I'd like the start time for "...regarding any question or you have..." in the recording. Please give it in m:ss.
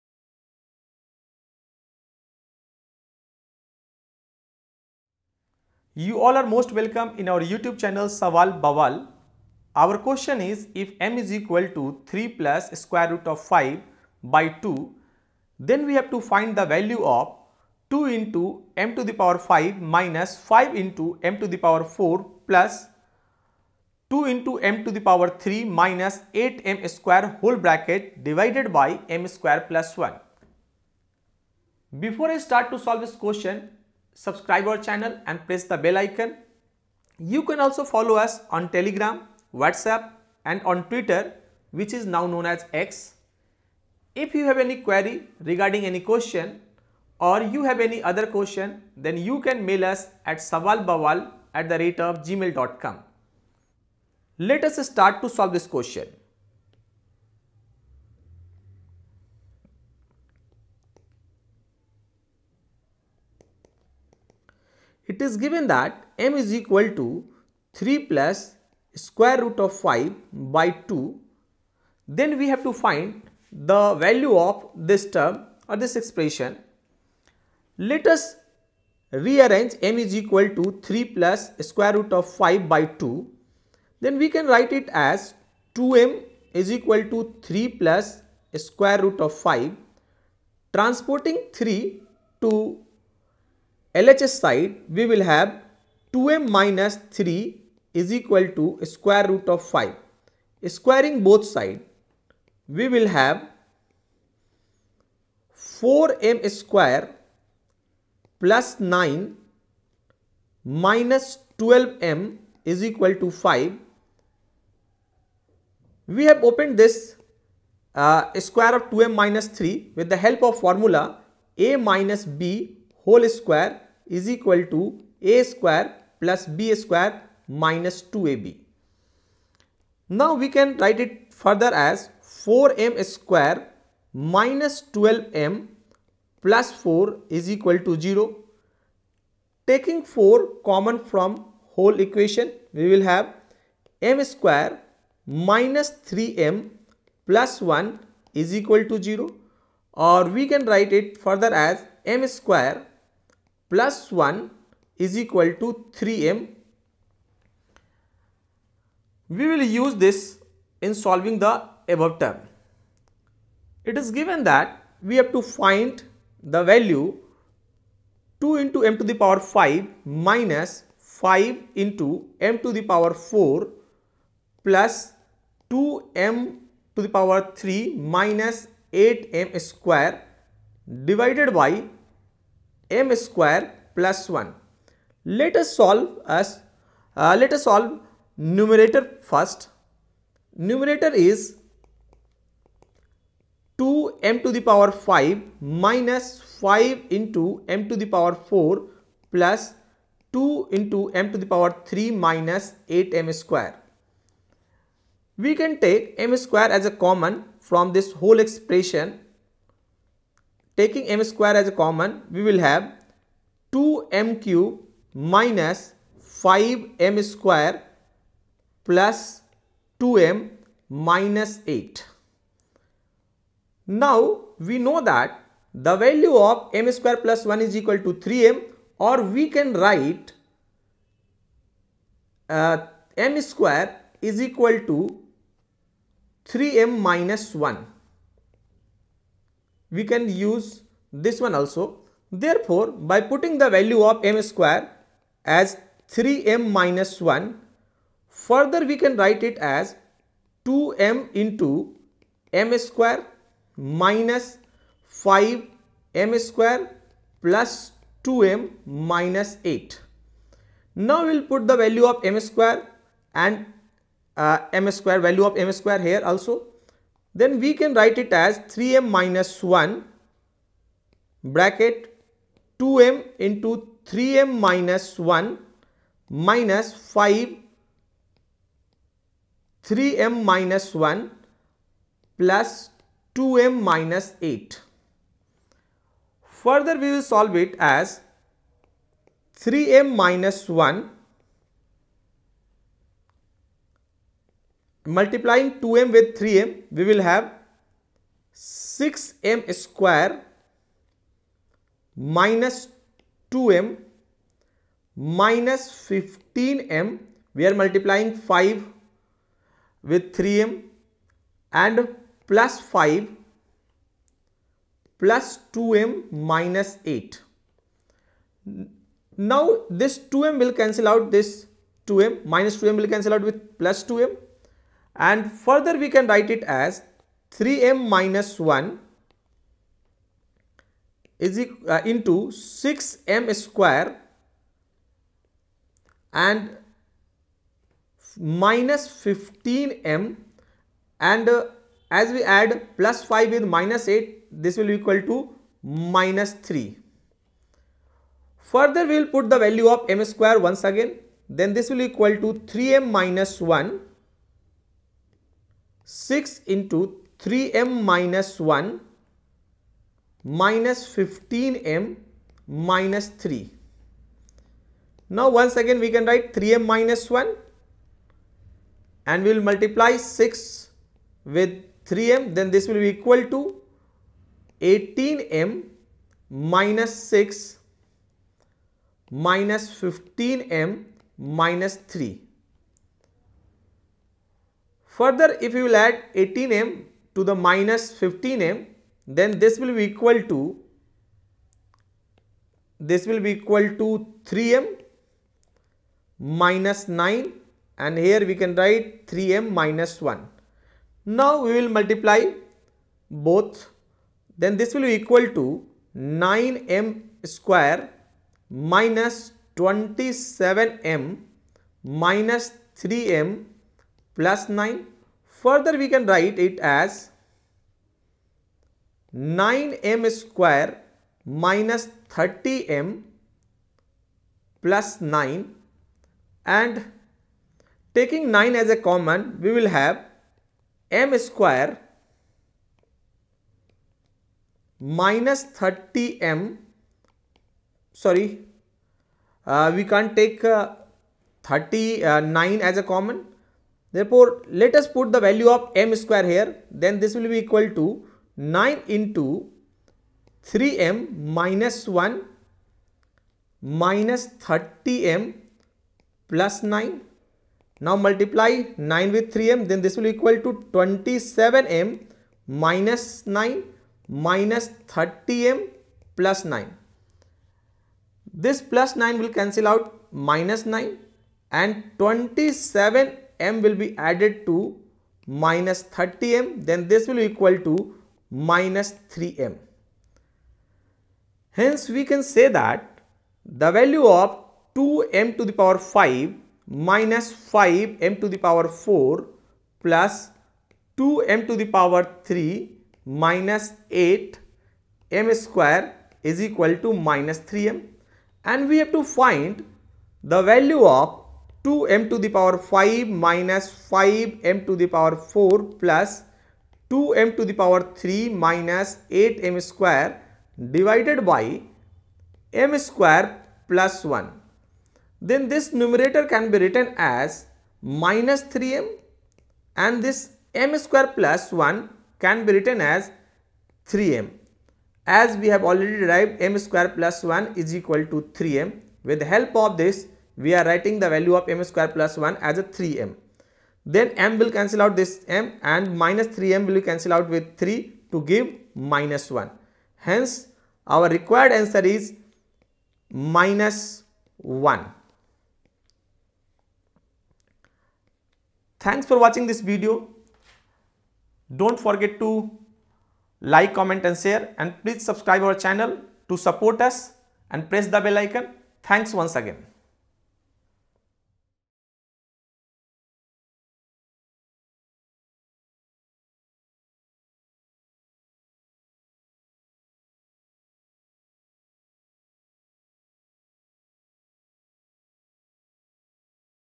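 0:45.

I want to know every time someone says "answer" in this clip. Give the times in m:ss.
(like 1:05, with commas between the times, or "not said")
9:01.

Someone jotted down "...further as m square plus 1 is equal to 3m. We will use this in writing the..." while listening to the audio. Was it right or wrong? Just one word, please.
wrong.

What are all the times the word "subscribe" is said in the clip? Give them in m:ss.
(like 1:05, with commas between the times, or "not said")
0:34, 9:15.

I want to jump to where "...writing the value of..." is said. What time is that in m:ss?
8:50.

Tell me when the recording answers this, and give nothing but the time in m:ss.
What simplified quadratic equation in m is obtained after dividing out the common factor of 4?
2:24.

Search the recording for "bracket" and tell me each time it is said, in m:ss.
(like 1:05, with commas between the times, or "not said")
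0:27, 4:31.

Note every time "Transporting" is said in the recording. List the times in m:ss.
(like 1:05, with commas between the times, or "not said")
1:30.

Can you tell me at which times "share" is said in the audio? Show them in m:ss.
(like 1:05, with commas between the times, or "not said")
9:14.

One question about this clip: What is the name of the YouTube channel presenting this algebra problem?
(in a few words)
Sawaal Bawaal.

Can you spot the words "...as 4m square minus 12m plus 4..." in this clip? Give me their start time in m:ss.
2:11.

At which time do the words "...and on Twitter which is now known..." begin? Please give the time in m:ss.
0:40.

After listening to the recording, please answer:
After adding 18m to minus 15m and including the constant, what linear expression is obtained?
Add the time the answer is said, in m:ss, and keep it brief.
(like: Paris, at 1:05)
3m - 9, at 6:34.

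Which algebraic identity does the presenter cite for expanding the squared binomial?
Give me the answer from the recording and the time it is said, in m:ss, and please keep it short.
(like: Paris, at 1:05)
a minus b whole square, at 2:01.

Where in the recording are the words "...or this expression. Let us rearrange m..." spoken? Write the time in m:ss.
1:15.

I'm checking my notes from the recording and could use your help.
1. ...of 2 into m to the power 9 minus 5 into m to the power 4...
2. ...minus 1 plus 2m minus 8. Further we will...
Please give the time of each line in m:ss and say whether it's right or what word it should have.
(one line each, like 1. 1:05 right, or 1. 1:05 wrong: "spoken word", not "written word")
1. 0:17 wrong: "5", not "9"
2. 4:40 right.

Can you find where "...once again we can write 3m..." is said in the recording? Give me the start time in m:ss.
6:05.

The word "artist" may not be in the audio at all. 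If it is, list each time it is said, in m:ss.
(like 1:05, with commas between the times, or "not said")
not said.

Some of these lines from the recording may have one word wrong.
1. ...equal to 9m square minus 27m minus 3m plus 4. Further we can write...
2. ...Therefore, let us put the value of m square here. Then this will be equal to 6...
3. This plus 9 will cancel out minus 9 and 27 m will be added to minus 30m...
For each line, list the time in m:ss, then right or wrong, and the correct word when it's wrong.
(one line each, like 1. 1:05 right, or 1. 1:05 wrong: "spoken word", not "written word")
1. 6:45 wrong: "9", not "4"
2. 7:24 wrong: "9", not "6"
3. 7:48 right.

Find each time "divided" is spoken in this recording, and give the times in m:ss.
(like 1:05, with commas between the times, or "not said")
0:28, 3:01, 8:30.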